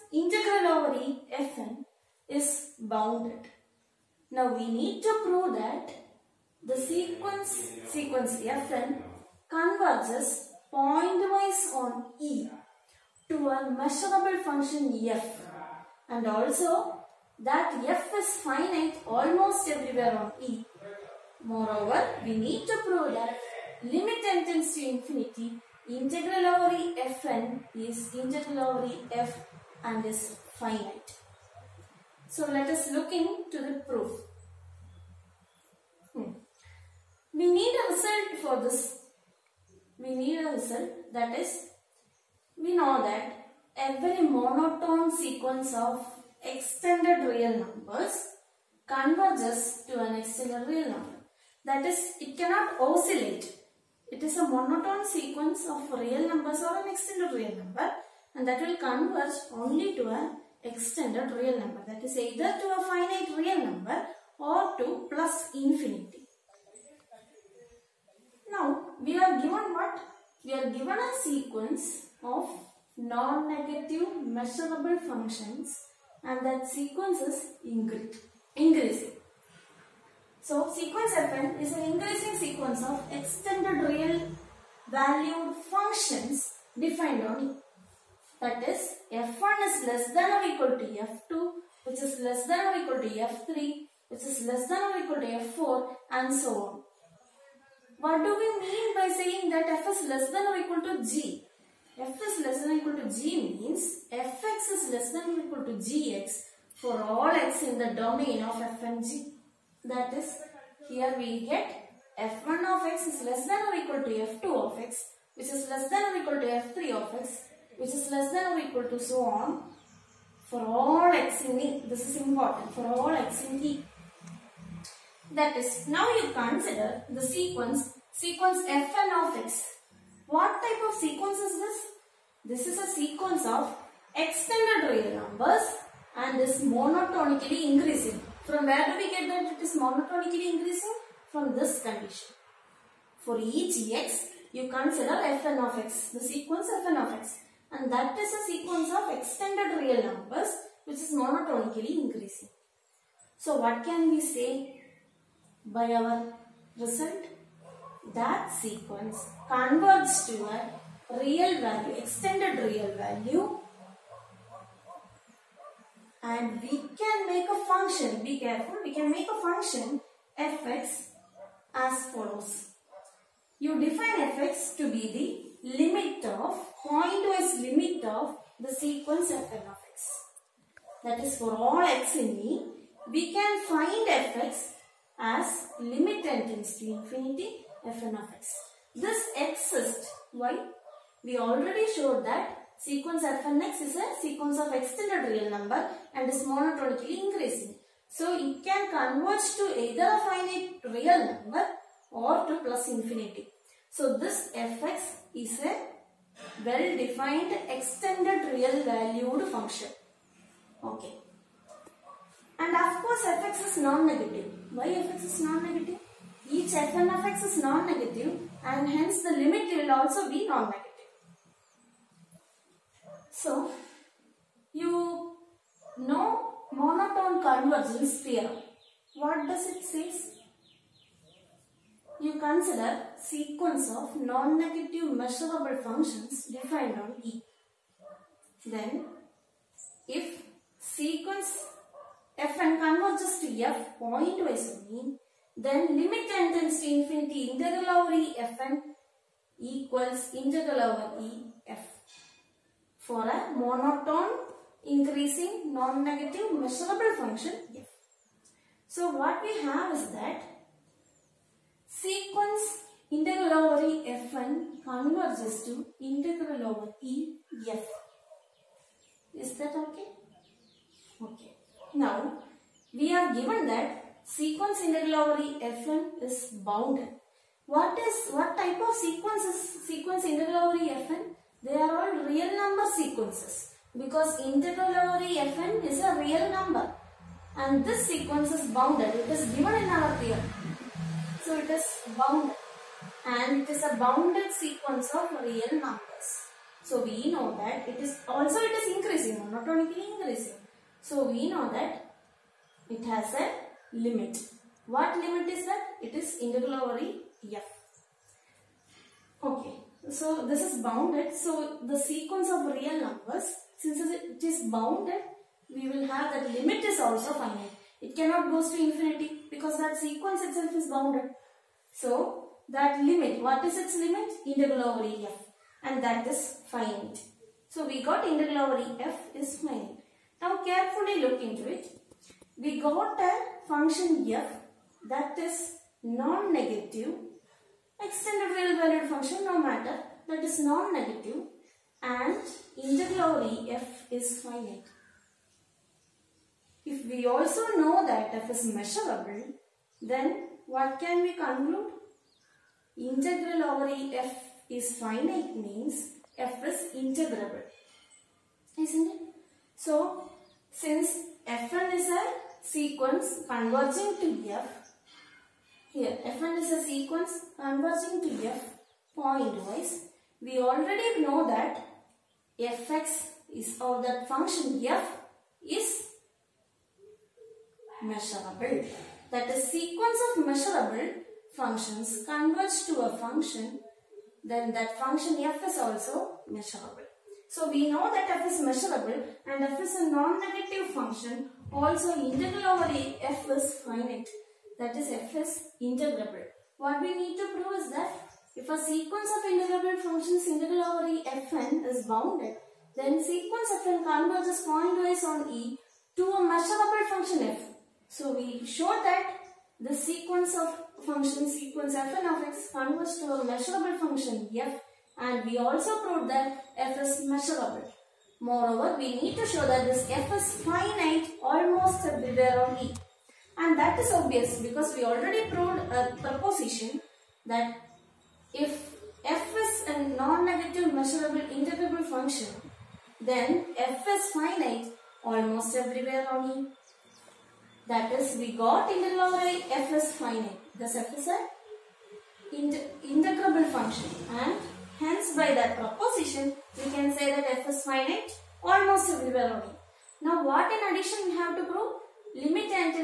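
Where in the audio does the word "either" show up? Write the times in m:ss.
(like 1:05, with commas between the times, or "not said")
1:02, 3:19.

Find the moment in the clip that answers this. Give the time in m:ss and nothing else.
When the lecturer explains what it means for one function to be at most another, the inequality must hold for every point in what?
1:48.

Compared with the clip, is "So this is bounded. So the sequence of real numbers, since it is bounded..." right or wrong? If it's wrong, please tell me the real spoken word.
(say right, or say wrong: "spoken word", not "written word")
right.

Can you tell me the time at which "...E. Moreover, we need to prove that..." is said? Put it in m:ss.
0:20.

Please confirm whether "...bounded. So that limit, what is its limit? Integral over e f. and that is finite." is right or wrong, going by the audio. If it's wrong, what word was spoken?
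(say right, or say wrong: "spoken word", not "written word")
right.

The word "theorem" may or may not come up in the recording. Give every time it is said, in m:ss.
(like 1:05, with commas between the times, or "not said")
3:48, 4:50.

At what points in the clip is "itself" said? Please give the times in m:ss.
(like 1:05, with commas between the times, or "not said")
5:20.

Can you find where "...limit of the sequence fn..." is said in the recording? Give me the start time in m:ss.
2:57.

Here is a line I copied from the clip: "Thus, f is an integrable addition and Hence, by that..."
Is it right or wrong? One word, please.
wrong.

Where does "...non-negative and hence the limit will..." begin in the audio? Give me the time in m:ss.
3:37.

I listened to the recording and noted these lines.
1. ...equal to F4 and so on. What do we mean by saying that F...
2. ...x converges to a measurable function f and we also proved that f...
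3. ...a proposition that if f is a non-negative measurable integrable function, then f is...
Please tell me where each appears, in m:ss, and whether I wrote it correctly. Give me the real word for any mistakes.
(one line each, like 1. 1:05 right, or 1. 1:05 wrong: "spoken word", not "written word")
1. 1:34 right
2. 6:52 right
3. 7:05 right.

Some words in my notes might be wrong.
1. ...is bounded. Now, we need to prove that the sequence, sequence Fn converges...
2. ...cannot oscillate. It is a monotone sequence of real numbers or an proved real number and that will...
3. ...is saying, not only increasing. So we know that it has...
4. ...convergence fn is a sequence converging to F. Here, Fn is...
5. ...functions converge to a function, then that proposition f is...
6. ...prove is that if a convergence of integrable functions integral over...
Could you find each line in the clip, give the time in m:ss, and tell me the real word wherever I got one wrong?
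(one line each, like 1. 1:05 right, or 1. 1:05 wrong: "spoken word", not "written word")
1. 0:02 right
2. 0:52 wrong: "extended", not "proved"
3. 4:58 wrong: "increasing", not "saying"
4. 6:00 wrong: "since", not "convergence"
5. 6:21 wrong: "function", not "proposition"
6. 6:37 wrong: "sequence", not "convergence".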